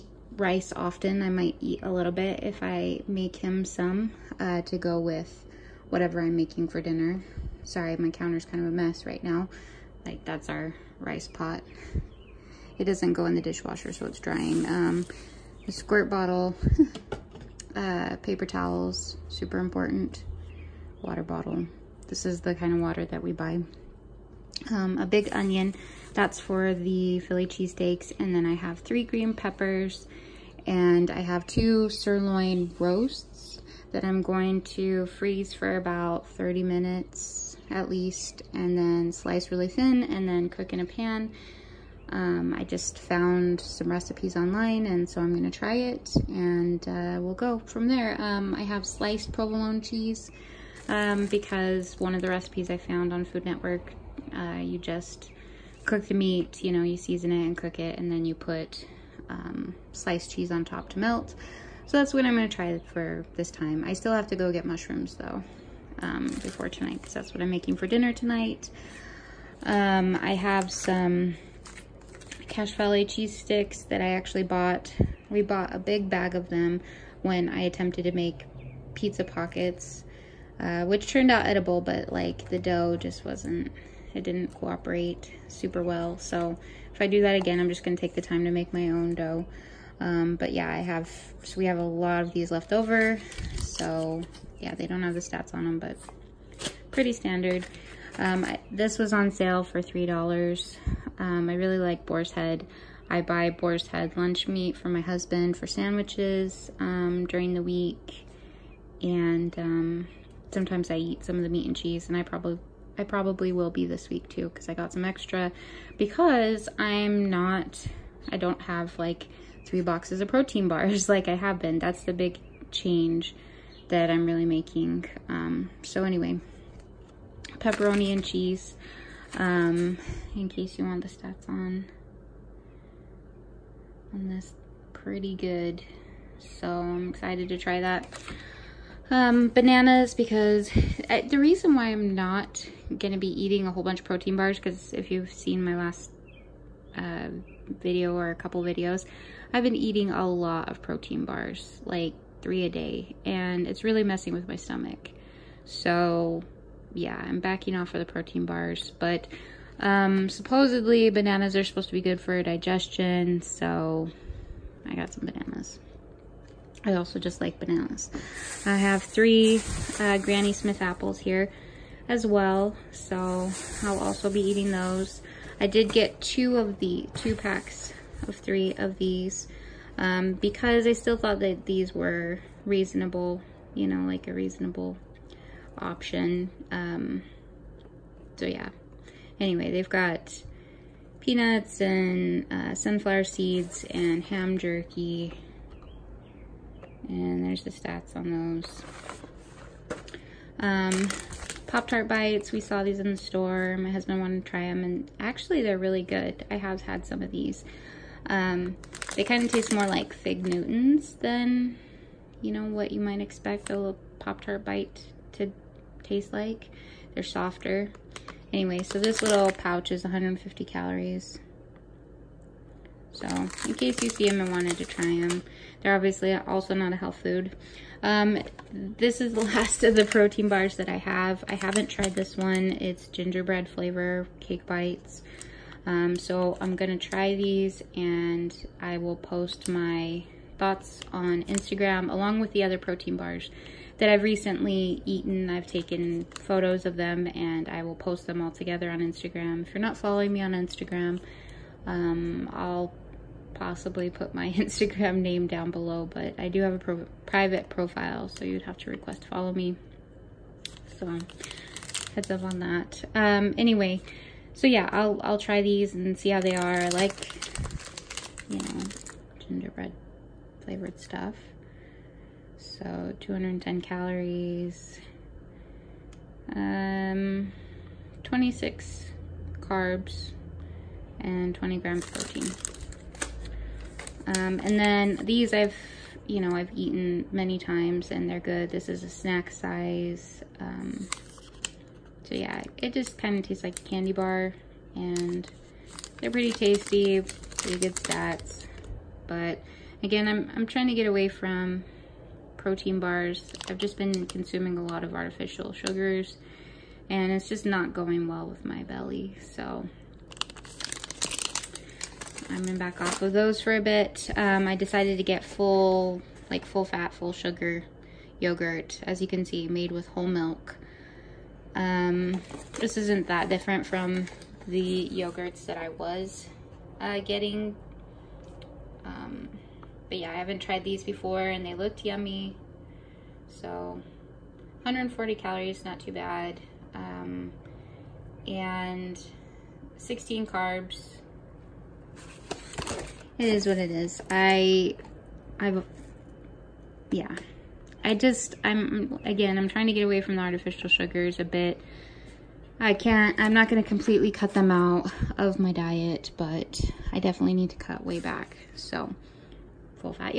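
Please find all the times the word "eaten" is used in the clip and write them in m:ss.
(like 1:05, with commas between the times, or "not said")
4:05, 4:46.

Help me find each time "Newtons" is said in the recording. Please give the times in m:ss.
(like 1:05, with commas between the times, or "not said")
3:30.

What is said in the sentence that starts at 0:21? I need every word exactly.
Water bottle, this is the kind of water that we buy.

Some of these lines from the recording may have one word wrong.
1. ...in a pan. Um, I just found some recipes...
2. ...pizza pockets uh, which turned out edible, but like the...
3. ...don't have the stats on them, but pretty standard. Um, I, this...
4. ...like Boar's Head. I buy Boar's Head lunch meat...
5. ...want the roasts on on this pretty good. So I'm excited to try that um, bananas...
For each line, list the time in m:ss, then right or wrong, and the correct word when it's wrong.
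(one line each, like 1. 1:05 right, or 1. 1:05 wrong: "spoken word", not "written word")
1. 0:40 right
2. 1:18 right
3. 1:34 right
4. 1:41 right
5. 2:10 wrong: "stats", not "roasts".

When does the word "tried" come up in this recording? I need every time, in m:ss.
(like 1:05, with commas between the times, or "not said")
3:51, 5:30.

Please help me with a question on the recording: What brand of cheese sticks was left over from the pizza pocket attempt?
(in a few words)
Cache Valley.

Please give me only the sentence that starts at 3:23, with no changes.
My husband wanted to try them, and actually they're really good.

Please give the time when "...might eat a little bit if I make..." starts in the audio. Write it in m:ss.
0:01.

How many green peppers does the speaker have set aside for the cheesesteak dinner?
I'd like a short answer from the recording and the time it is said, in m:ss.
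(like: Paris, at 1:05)
3, at 0:28.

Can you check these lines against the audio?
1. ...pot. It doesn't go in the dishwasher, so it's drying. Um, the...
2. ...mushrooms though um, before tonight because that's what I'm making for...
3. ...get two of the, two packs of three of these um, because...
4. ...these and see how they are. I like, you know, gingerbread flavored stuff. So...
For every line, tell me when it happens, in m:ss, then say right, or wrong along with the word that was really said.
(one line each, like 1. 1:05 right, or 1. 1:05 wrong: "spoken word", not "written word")
1. 0:11 right
2. 1:04 right
3. 2:55 right
4. 4:25 right.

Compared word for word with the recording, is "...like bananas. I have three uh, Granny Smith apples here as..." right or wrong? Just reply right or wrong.
right.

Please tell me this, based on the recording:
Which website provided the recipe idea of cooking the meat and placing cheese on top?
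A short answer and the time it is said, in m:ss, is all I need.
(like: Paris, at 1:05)
Food Network, at 0:53.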